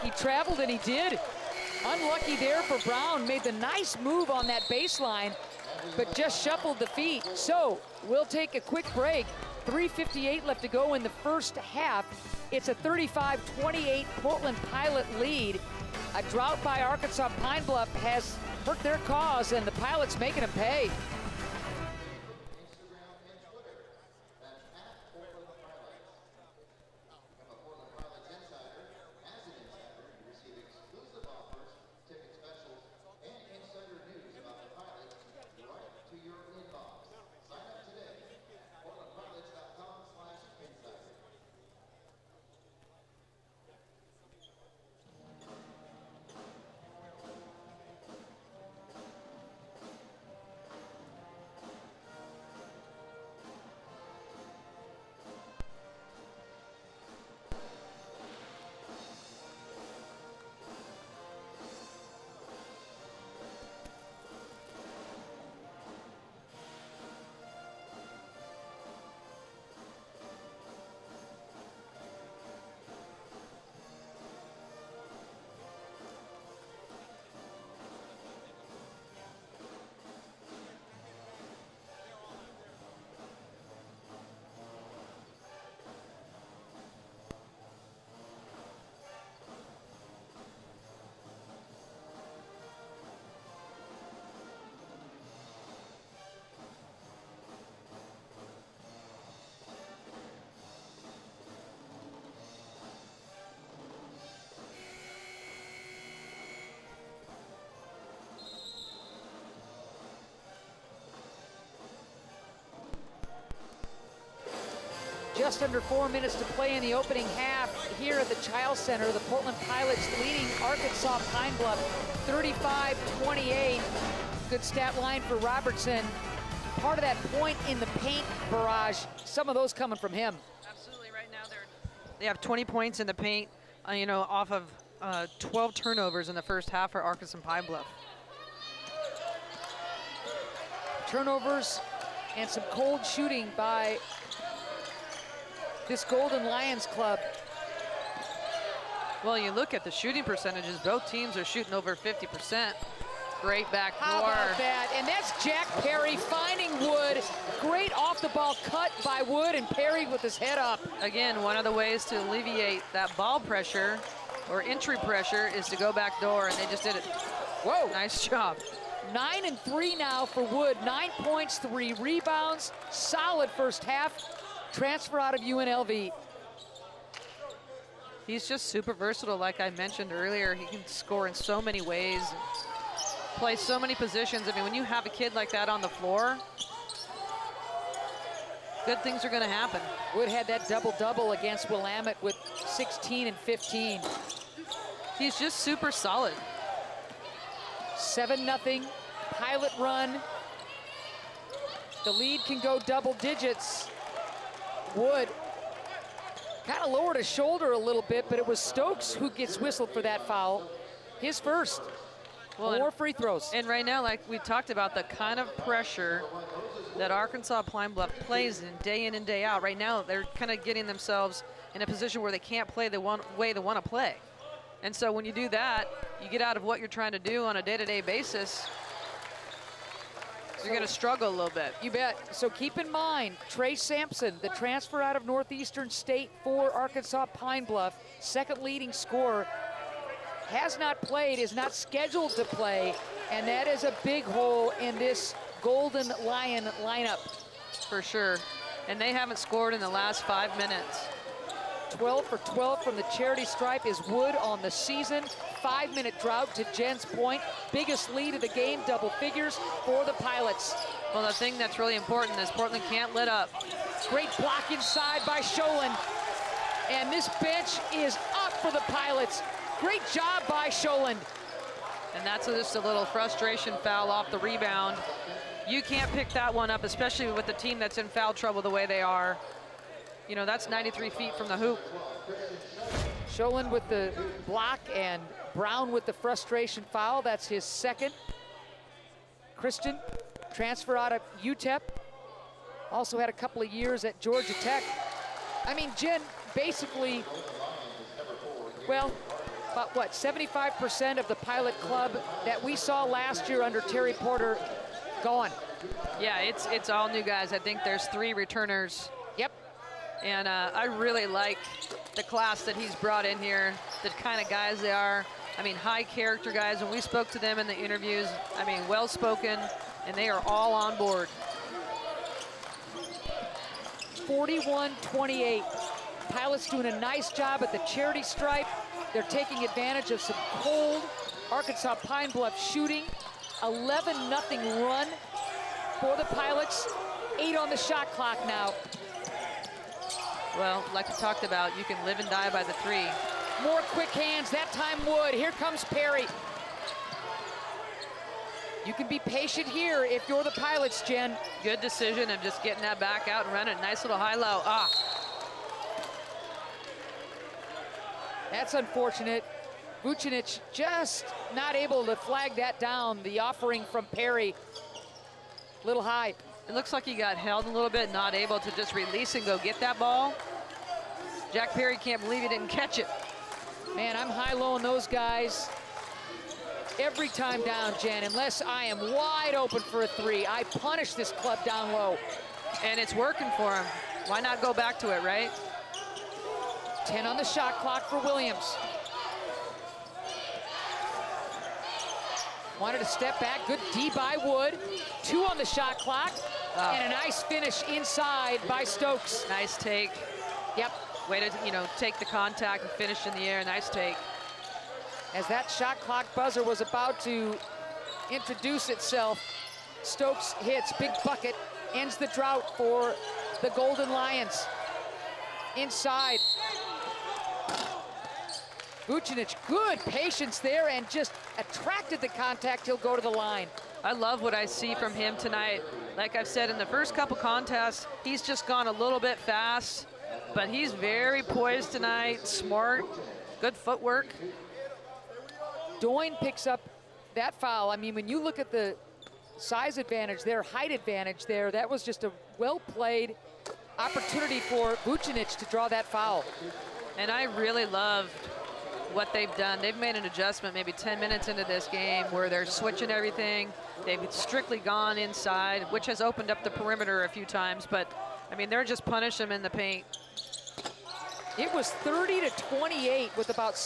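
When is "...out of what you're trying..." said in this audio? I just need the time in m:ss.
3:46.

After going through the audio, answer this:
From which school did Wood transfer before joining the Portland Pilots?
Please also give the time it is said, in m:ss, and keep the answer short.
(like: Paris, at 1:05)
UNLV, at 2:55.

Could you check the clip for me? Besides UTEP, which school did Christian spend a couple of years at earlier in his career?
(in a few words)
Georgia Tech.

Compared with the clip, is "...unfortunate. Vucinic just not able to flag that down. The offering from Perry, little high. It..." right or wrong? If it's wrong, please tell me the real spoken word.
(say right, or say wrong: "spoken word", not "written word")
right.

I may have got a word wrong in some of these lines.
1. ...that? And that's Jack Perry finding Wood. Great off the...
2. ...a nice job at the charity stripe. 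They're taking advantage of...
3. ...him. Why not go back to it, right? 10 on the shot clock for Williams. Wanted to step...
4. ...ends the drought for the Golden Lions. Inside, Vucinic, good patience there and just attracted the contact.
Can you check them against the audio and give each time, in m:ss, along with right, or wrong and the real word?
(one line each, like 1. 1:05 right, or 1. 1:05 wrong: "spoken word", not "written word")
1. 2:34 right
2. 5:26 right
3. 6:23 right
4. 6:51 right.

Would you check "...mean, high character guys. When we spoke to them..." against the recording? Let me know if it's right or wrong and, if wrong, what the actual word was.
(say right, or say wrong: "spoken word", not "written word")
right.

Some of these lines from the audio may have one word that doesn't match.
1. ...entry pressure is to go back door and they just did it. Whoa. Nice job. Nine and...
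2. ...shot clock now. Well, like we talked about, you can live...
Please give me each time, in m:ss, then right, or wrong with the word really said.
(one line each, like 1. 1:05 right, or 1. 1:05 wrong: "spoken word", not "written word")
1. 2:44 right
2. 5:37 right.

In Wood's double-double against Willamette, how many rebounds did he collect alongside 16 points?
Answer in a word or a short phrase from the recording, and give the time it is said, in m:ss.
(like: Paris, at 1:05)
15, at 3:13.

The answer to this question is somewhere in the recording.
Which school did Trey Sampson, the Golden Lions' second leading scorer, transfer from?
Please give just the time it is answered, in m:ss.
3:55.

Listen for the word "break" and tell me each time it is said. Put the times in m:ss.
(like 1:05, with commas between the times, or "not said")
0:08.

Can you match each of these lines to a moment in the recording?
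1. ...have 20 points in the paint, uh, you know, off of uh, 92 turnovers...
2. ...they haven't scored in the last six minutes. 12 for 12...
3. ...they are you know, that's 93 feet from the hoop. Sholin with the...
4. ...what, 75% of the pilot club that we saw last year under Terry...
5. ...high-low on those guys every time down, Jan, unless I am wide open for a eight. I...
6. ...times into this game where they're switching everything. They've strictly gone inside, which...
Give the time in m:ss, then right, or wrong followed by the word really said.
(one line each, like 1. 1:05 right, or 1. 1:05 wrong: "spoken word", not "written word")
1. 2:12 wrong: "12", not "92"
2. 4:09 wrong: "five", not "six"
3. 4:38 right
4. 4:59 right
5. 6:14 wrong: "three", not "eight"
6. 7:31 wrong: "minutes", not "times".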